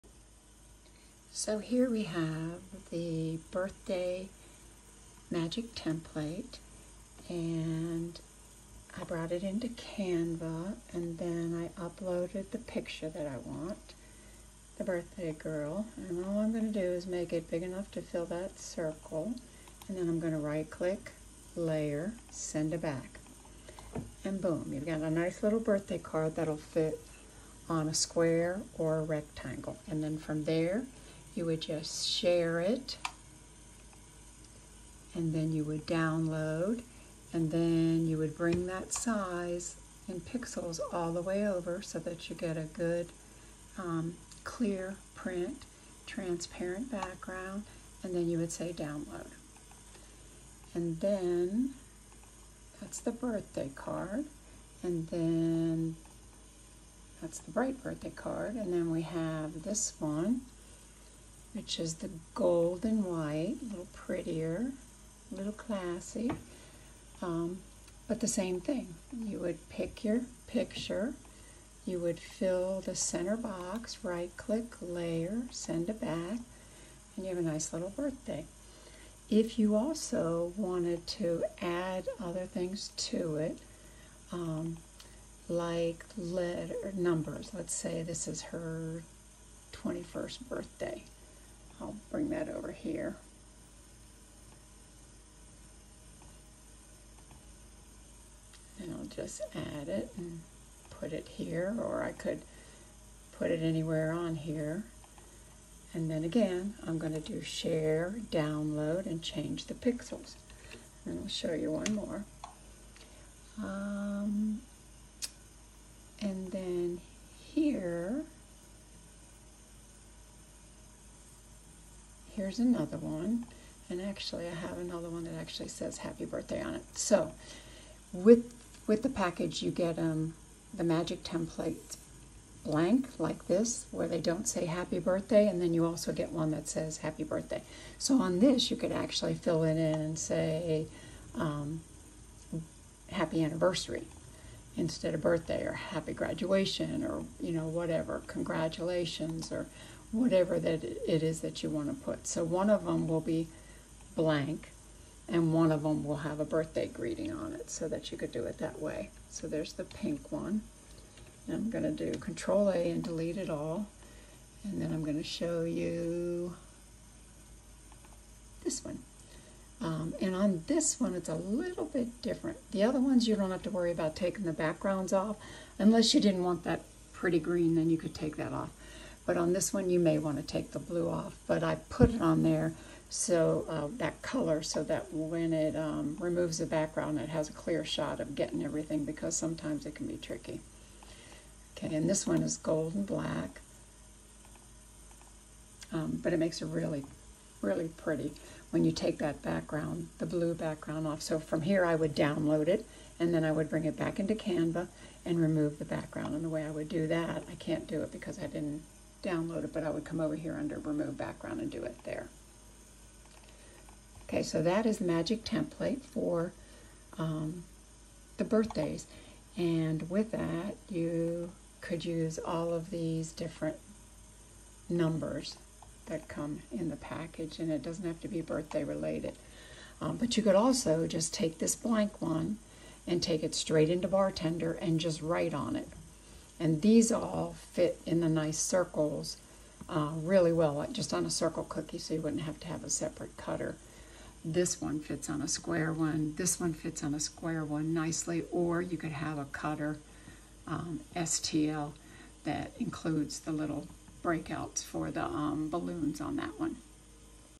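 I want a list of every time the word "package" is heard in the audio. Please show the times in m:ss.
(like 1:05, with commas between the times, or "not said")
2:09, 3:46.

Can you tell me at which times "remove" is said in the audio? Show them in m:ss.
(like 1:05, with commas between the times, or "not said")
3:06, 3:25, 3:30.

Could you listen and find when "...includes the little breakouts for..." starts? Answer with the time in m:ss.
4:12.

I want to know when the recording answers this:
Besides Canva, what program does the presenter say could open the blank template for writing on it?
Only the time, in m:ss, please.
3:54.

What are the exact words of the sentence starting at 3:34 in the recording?
Okay, so that is the magic template for um, the birthdays.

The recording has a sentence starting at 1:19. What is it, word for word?
If you also wanted to add other things to it, um, like letter numbers, let's say this is her 21st birthday.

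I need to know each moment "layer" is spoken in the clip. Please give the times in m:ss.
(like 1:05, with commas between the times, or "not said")
0:21, 1:14.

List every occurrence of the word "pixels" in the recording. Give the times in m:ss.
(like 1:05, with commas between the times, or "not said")
0:40, 1:49.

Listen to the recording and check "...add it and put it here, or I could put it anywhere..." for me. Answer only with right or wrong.
right.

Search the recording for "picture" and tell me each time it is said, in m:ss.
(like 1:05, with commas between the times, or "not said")
0:12, 1:10.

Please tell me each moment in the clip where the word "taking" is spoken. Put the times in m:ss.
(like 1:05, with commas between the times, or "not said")
2:54.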